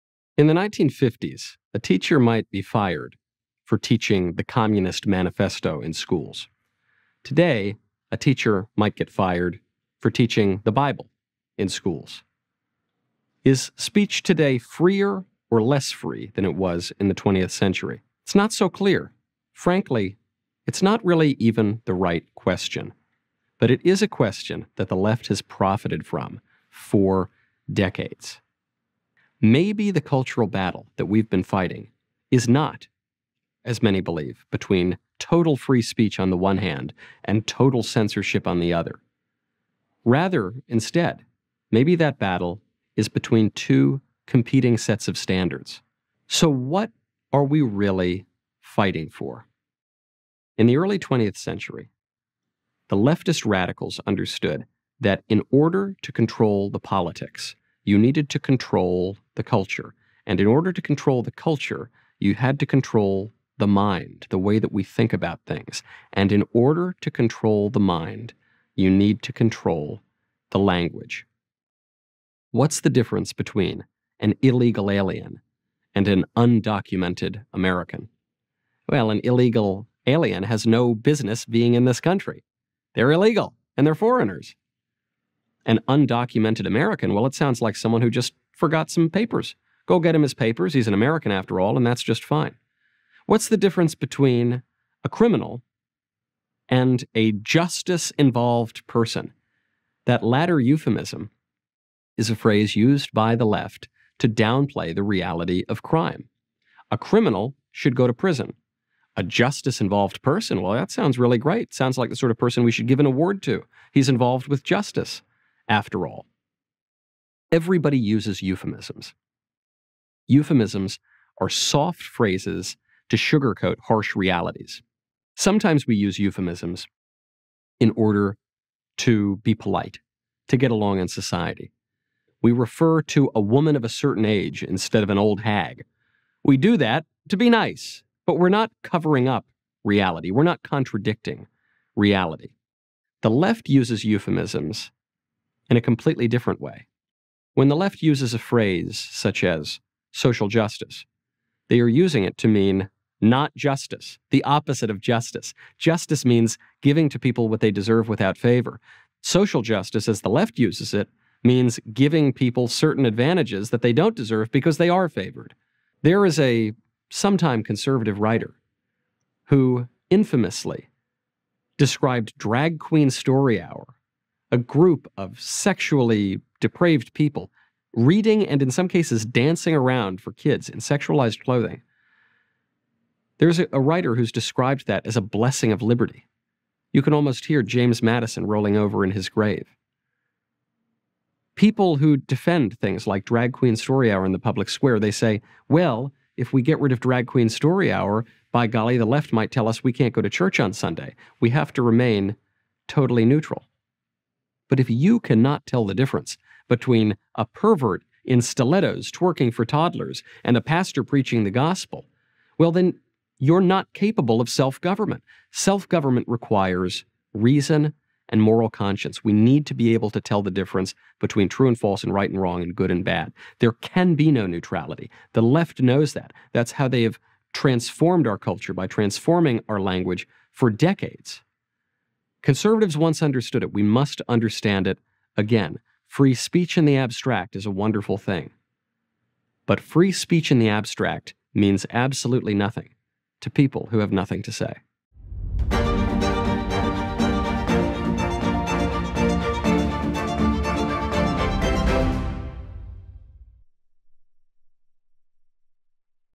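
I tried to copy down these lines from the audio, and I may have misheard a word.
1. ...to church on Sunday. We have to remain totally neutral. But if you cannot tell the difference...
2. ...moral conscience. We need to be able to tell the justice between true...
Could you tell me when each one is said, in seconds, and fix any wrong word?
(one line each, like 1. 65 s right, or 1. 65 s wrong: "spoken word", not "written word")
1. 200 s right
2. 218 s wrong: "difference", not "justice".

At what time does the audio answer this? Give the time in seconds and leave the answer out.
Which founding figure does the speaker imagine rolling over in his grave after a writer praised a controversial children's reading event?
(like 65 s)
187 s.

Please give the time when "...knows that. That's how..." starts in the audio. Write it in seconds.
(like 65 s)
225 s.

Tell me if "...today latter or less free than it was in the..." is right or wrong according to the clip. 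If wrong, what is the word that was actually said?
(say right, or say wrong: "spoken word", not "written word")
wrong: "freer", not "latter".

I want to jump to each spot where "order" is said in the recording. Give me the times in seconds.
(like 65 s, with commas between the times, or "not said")
55 s, 60 s, 66 s, 127 s.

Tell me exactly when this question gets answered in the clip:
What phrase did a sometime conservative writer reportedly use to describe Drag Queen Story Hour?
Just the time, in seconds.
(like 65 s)
185 s.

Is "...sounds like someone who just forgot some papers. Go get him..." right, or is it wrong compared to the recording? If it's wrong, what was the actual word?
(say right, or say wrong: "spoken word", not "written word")
right.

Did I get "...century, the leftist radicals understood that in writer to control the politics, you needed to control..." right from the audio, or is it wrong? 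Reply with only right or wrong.
wrong.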